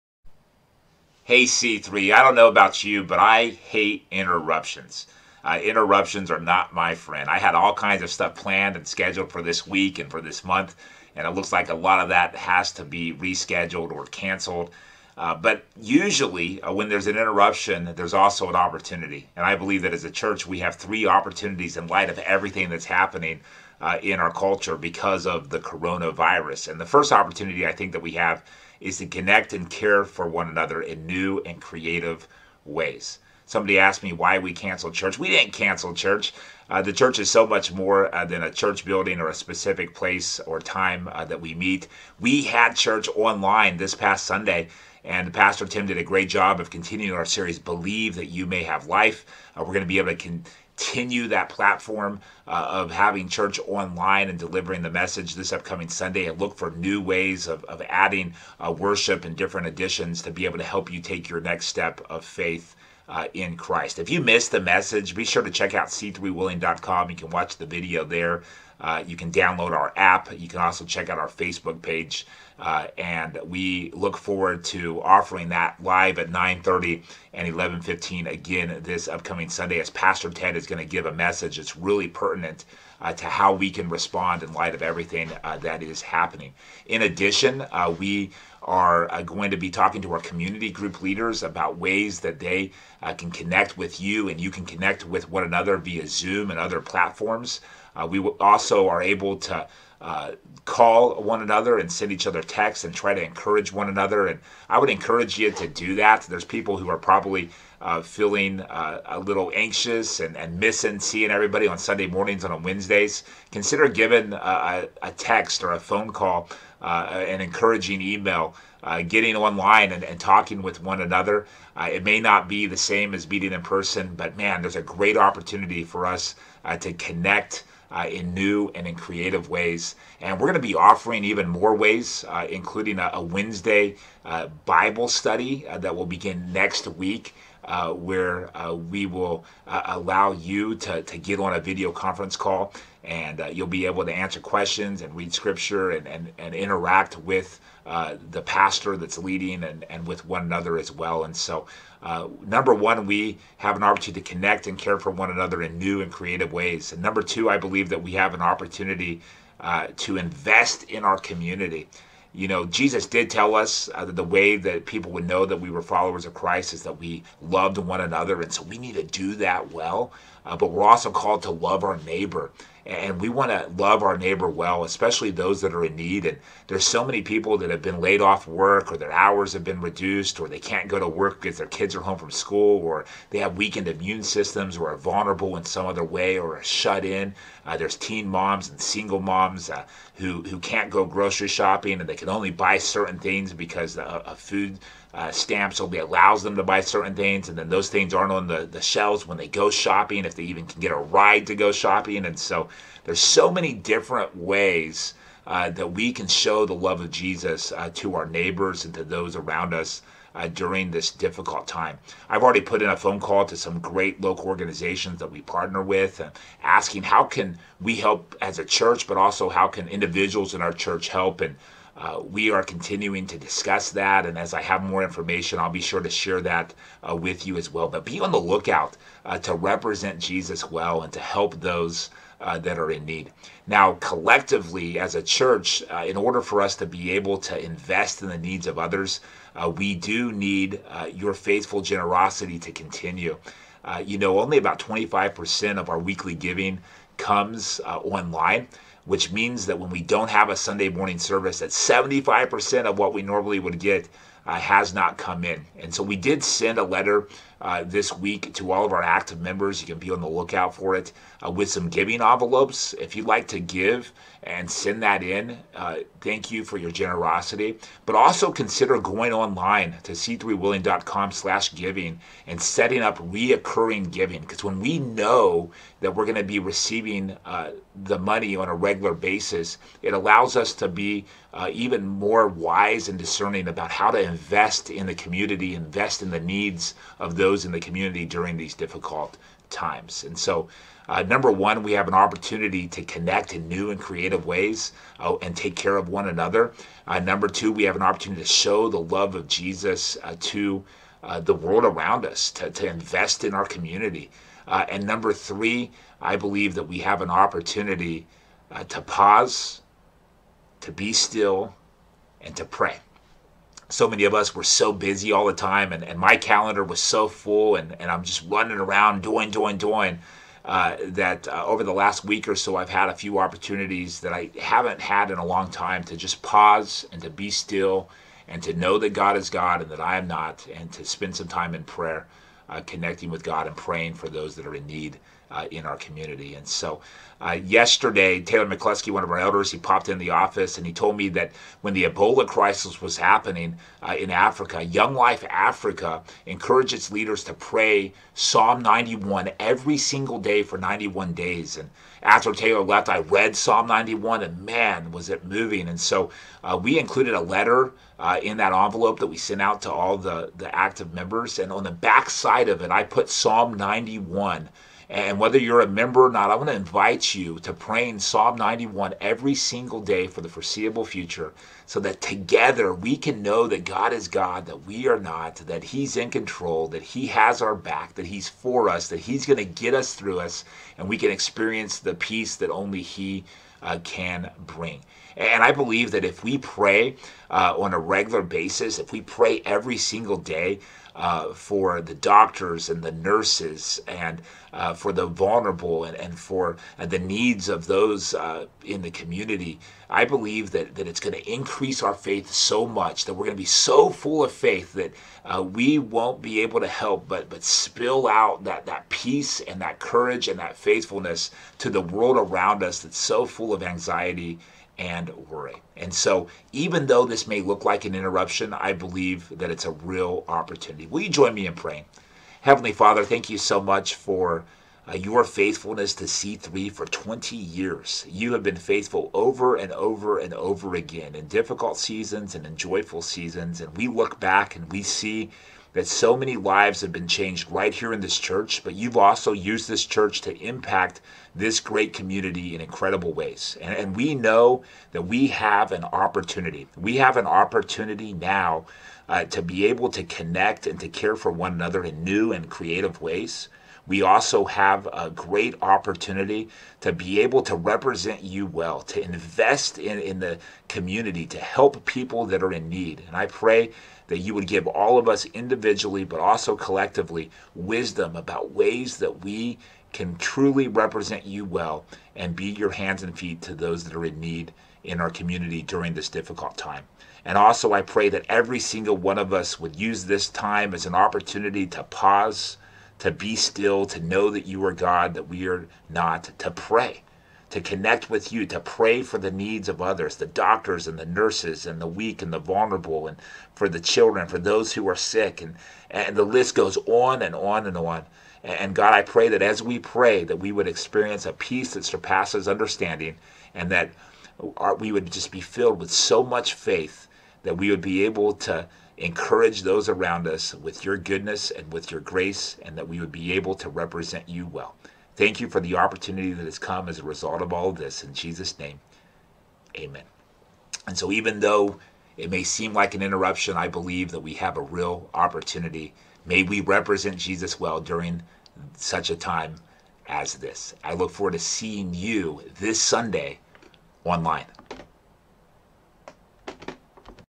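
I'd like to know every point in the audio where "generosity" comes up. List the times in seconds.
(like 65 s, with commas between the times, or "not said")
241 s, 266 s.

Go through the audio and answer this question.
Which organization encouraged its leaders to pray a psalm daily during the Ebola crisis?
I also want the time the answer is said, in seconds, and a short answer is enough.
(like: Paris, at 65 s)
Young Life Africa, at 344 s.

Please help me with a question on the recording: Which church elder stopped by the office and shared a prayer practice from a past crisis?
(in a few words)
Taylor McCluskey.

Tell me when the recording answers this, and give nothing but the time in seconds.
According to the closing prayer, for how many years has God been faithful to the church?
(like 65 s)
427 s.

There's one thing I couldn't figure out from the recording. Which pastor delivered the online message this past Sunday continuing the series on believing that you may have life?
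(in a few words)
Pastor Tim.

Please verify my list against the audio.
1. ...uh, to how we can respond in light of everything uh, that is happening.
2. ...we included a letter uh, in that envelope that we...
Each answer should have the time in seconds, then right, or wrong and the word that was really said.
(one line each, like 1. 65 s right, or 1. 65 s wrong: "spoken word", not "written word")
1. 83 s right
2. 356 s right.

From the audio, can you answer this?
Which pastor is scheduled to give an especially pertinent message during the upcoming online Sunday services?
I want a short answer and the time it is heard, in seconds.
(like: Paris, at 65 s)
Pastor Ted, at 79 s.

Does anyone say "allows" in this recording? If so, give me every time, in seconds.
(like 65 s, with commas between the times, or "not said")
139 s, 195 s, 280 s.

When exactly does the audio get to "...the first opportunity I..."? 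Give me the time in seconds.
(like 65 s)
26 s.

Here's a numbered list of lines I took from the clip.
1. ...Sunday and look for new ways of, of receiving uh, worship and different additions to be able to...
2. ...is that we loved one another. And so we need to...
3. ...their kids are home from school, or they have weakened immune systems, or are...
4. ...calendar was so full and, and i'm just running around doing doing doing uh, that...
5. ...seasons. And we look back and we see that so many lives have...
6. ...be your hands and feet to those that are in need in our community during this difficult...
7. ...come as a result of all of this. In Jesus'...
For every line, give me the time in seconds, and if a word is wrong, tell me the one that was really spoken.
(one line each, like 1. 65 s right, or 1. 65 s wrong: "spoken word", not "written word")
1. 55 s wrong: "adding", not "receiving"
2. 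166 s right
3. 181 s right
4. 316 s right
5. 433 s right
6. 472 s right
7. 516 s right.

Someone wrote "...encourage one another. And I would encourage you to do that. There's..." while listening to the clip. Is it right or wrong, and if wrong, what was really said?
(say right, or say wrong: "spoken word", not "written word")
right.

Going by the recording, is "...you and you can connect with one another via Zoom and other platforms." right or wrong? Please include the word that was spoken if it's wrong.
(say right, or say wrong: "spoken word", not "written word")
right.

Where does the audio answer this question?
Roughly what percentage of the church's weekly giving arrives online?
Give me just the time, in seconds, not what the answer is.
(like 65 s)
244 s.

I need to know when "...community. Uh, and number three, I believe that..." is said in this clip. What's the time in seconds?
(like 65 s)
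303 s.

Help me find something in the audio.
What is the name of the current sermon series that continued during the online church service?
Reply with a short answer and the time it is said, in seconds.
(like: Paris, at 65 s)
Believe That You May Have Life, at 47 s.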